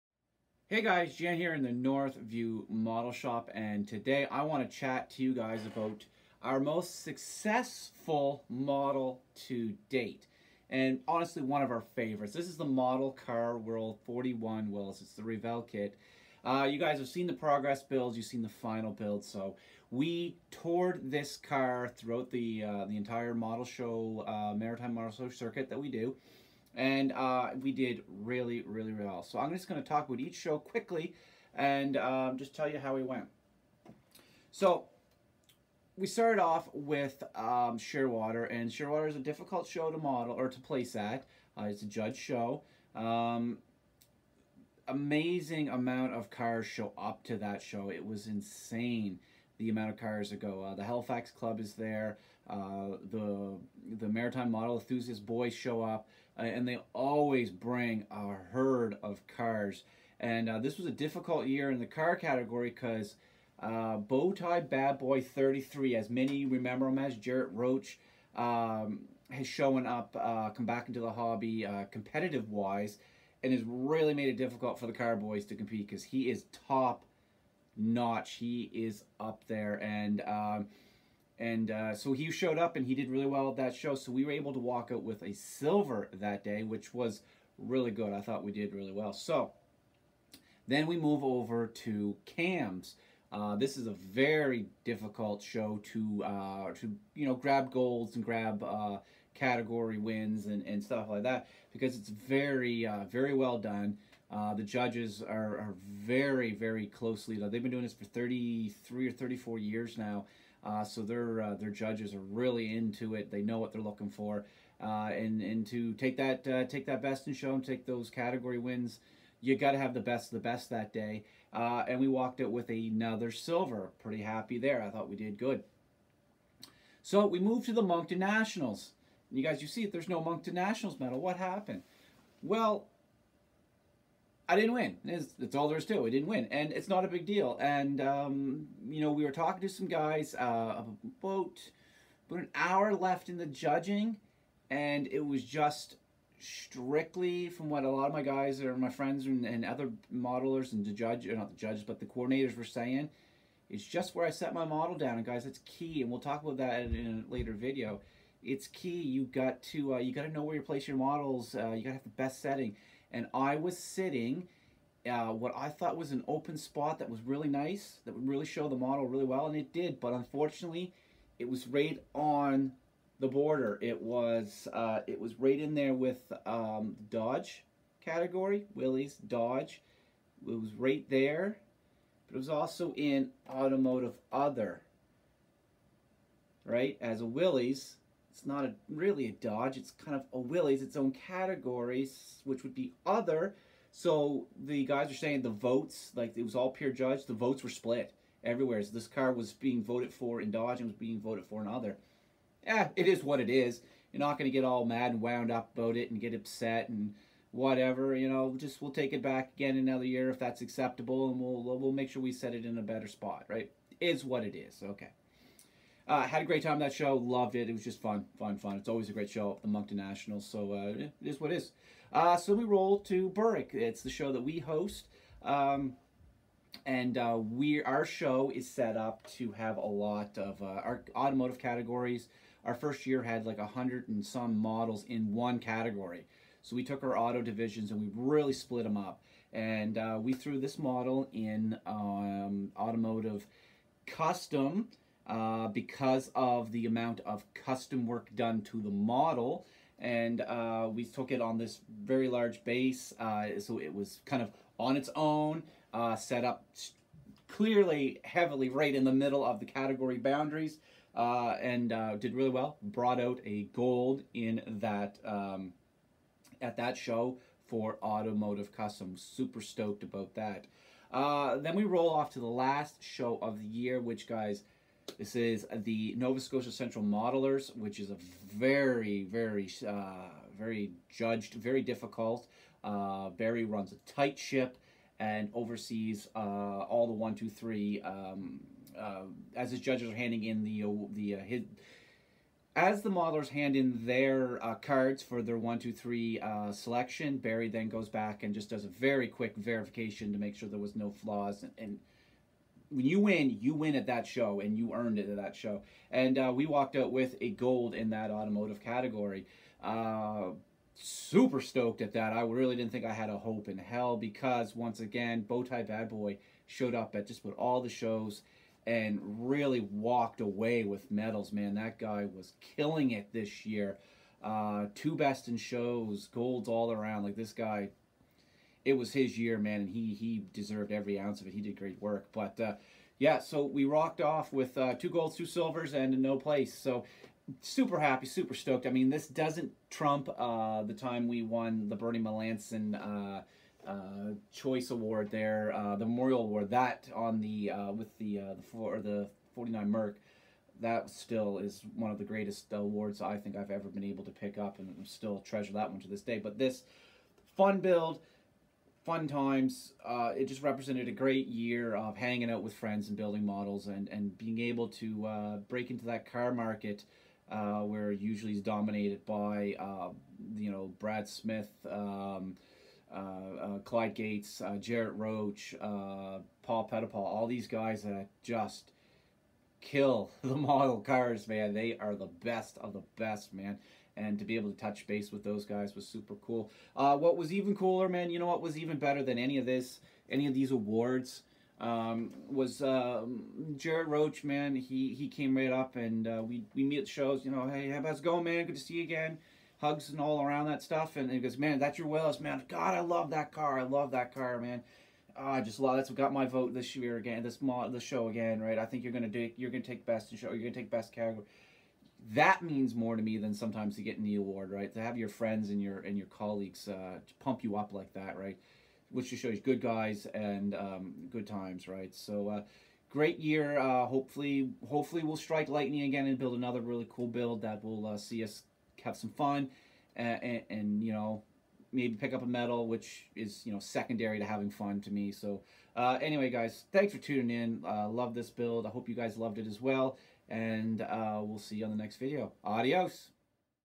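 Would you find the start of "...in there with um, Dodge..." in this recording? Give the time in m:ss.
2:55.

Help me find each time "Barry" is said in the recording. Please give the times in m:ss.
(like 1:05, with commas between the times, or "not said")
4:43, 4:57.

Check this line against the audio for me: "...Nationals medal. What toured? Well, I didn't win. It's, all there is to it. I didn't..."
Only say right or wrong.
wrong.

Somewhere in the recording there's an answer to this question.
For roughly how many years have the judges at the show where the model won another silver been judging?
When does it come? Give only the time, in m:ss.
1:48.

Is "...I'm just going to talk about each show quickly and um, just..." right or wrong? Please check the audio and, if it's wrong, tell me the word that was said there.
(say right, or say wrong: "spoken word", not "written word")
right.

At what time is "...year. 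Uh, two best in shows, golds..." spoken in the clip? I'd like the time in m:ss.
5:23.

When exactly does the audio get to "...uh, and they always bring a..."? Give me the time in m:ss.
0:56.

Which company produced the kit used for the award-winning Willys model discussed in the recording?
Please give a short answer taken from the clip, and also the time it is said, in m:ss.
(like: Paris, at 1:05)
Revell, at 0:15.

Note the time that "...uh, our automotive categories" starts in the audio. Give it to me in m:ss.
3:50.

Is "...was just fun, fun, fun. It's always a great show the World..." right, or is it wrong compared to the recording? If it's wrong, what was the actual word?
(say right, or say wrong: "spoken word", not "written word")
wrong: "Moncton", not "World".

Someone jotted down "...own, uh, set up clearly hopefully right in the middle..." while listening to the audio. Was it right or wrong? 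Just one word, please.
wrong.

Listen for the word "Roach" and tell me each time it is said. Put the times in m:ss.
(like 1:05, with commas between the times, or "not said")
1:07, 6:15, 6:34.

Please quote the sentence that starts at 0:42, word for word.
Um, amazing amount of cars show up to that show.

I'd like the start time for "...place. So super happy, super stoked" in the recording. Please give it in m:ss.
5:36.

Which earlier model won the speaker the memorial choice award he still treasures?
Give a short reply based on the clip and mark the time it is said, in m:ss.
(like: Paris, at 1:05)
49 Merc, at 5:49.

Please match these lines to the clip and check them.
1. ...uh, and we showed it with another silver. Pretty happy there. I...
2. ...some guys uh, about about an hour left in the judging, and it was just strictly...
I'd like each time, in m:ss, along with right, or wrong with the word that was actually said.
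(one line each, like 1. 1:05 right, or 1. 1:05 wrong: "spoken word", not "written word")
1. 2:01 wrong: "walked", not "showed"
2. 2:19 right.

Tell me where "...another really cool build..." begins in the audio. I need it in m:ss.
7:06.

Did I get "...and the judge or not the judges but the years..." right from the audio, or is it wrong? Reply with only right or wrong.
wrong.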